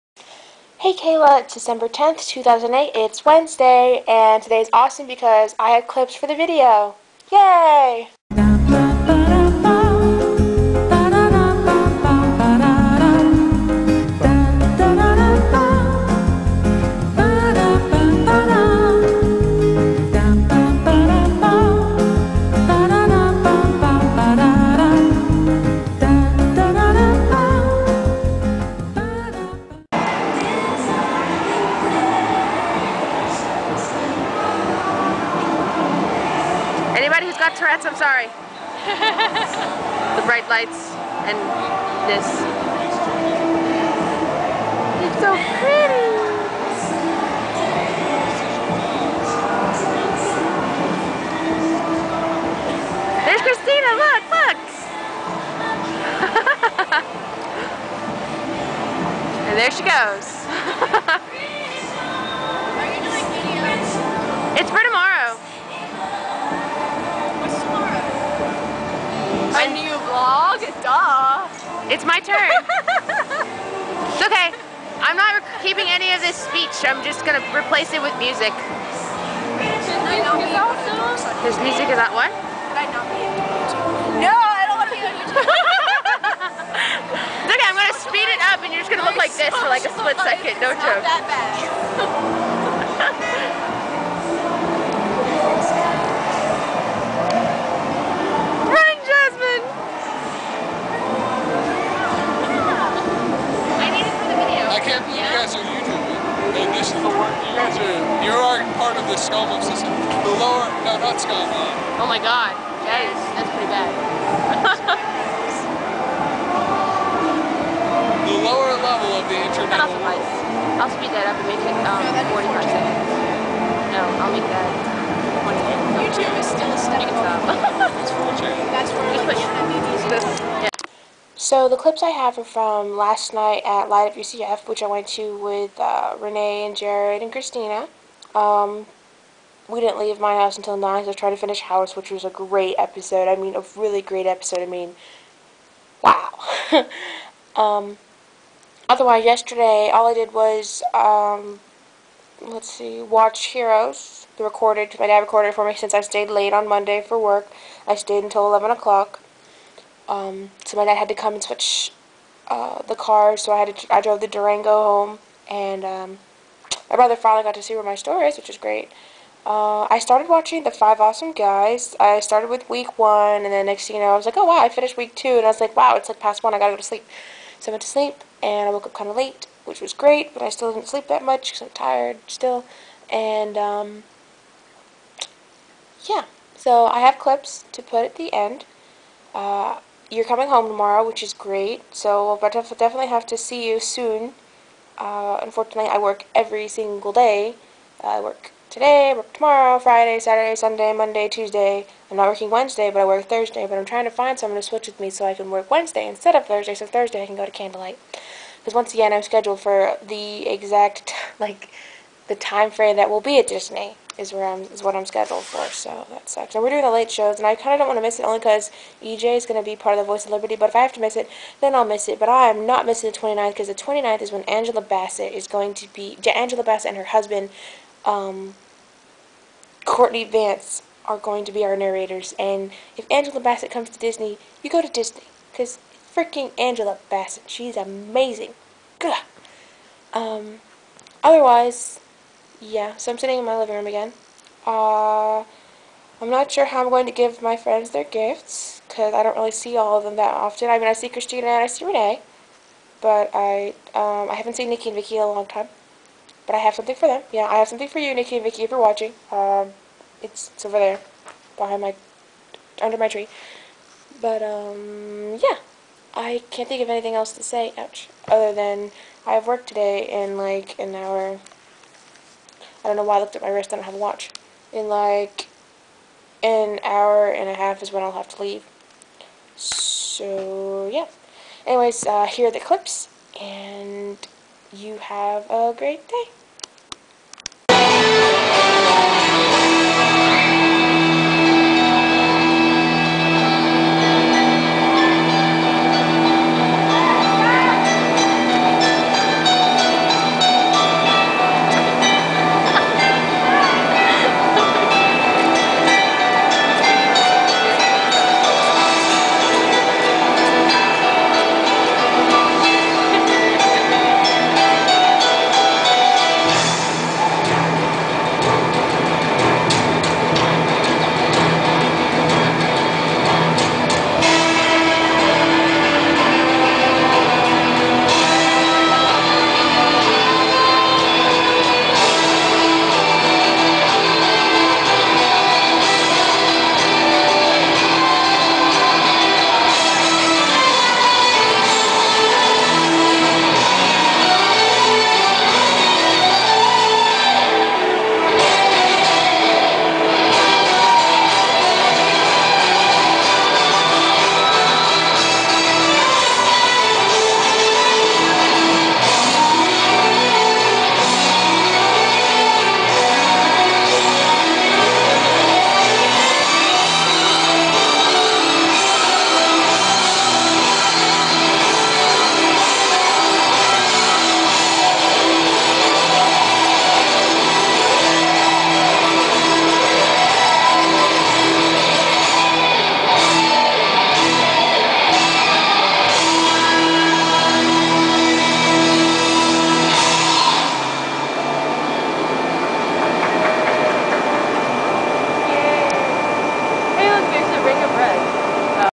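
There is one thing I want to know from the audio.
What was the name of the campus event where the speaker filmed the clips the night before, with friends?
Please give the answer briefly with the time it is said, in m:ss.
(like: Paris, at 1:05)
Light Up UCF, at 2:13.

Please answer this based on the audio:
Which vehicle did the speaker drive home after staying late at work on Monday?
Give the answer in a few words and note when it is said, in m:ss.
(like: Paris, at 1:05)
Durango, at 2:44.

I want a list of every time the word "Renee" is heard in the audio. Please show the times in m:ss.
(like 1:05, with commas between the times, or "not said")
2:16, 4:11.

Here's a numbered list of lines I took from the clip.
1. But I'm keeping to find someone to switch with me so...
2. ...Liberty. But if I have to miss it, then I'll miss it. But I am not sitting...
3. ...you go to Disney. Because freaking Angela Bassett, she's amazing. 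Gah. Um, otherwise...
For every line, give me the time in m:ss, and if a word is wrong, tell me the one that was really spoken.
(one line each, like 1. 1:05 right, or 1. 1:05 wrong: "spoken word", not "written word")
1. 3:23 wrong: "trying", not "keeping"
2. 3:40 wrong: "missing", not "sitting"
3. 3:54 right.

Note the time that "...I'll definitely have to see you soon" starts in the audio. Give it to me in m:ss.
3:12.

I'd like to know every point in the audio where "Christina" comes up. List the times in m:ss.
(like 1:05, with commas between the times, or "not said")
0:53, 2:17, 4:11.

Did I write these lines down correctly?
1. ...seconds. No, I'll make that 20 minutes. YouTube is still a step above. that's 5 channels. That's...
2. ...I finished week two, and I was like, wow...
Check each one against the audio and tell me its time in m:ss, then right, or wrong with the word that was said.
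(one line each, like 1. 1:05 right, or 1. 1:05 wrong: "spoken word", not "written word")
1. 2:02 wrong: "4", not "5"
2. 2:54 right.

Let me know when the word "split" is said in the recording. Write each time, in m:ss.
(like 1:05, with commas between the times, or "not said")
1:29.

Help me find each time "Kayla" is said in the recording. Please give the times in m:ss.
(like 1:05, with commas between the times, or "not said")
0:00.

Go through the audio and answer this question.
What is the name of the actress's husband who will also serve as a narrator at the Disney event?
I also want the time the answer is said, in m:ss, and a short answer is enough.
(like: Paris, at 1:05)
Courtney Vance, at 3:49.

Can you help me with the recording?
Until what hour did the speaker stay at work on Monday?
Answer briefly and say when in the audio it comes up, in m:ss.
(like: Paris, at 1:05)
11 o'clock, at 2:38.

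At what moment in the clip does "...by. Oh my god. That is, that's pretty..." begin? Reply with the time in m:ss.
1:51.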